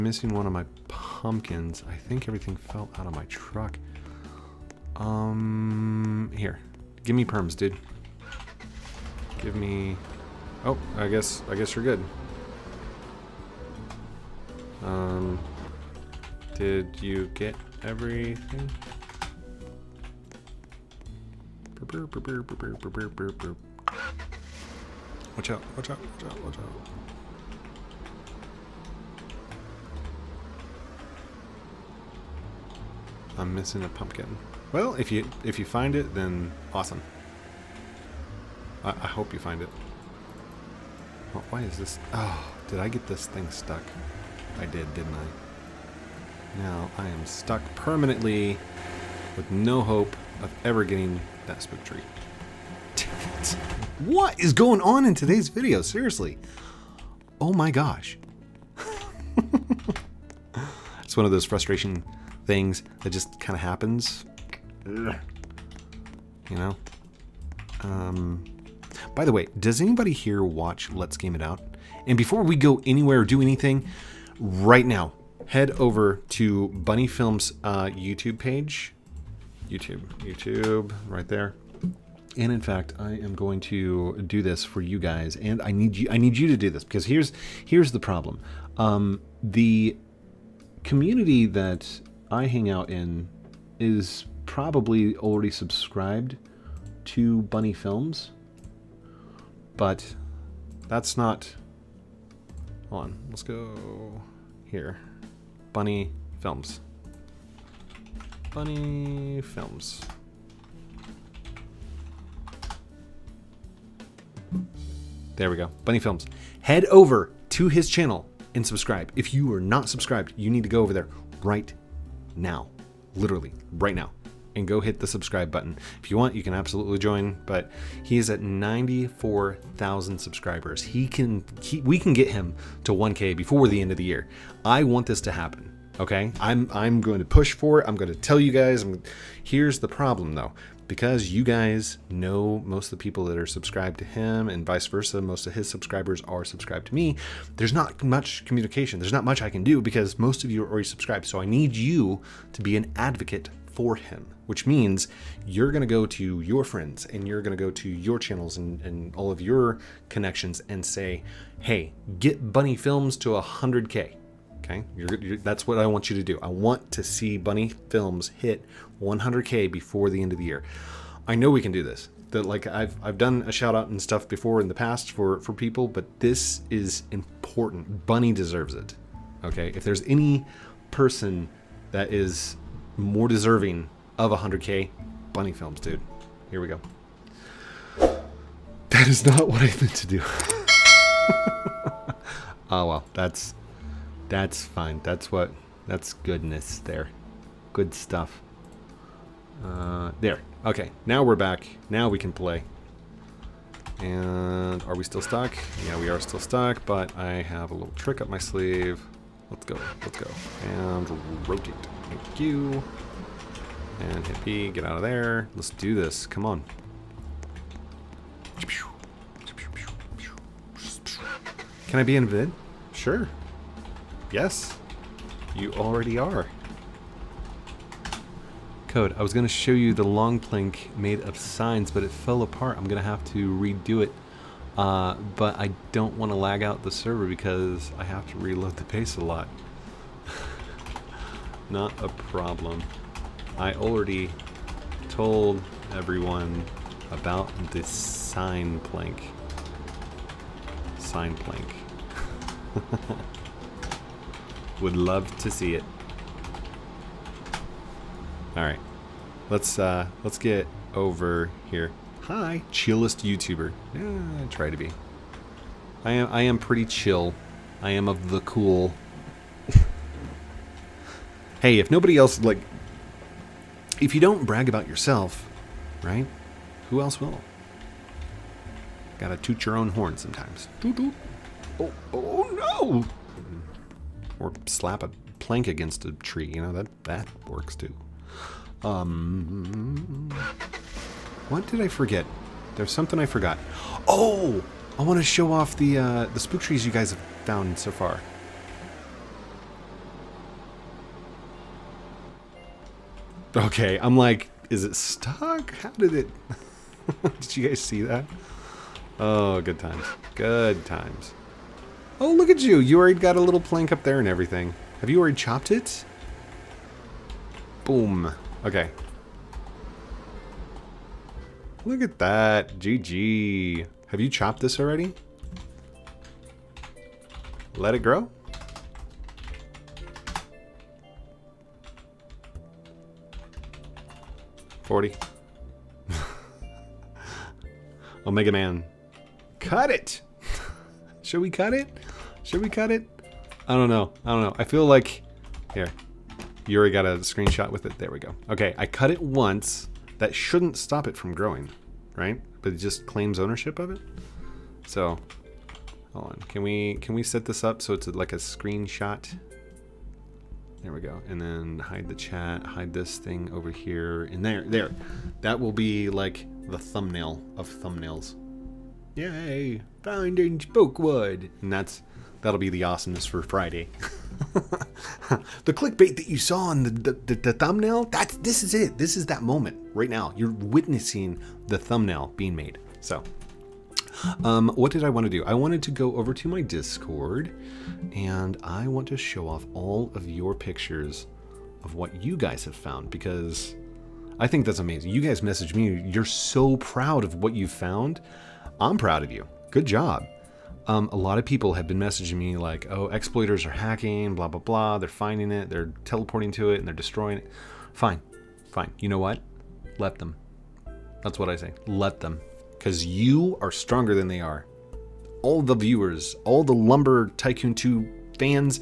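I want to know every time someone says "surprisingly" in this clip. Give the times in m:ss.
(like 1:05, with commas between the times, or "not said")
not said.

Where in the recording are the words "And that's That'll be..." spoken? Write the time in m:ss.
6:11.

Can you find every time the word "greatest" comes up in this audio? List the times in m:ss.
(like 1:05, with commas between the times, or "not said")
not said.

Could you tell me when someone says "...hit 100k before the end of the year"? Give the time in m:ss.
2:48.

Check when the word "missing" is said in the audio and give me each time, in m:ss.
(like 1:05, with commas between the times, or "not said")
0:00, 0:33.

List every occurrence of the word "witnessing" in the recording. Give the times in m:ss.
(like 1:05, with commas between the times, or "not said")
6:20.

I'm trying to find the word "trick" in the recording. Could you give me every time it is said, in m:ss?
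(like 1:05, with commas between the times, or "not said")
3:27.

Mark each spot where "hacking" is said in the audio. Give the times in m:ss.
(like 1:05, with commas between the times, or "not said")
6:43.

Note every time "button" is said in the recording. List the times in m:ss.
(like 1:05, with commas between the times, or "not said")
2:05.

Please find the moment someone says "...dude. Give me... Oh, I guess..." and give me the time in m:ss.
0:07.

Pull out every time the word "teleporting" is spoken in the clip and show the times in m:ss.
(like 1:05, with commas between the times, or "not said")
6:46.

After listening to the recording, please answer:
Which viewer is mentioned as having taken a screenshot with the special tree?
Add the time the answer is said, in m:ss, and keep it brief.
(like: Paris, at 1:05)
Yuri, at 5:46.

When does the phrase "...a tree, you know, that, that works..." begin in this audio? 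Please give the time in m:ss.
4:46.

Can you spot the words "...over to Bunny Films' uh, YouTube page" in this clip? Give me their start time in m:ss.
1:15.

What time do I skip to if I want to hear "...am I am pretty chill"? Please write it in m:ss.
4:26.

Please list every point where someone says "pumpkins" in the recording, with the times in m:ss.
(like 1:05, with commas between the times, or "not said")
0:00, 0:33.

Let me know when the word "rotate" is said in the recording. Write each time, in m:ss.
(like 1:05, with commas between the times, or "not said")
3:31.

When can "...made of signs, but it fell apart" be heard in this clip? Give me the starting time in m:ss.
3:50.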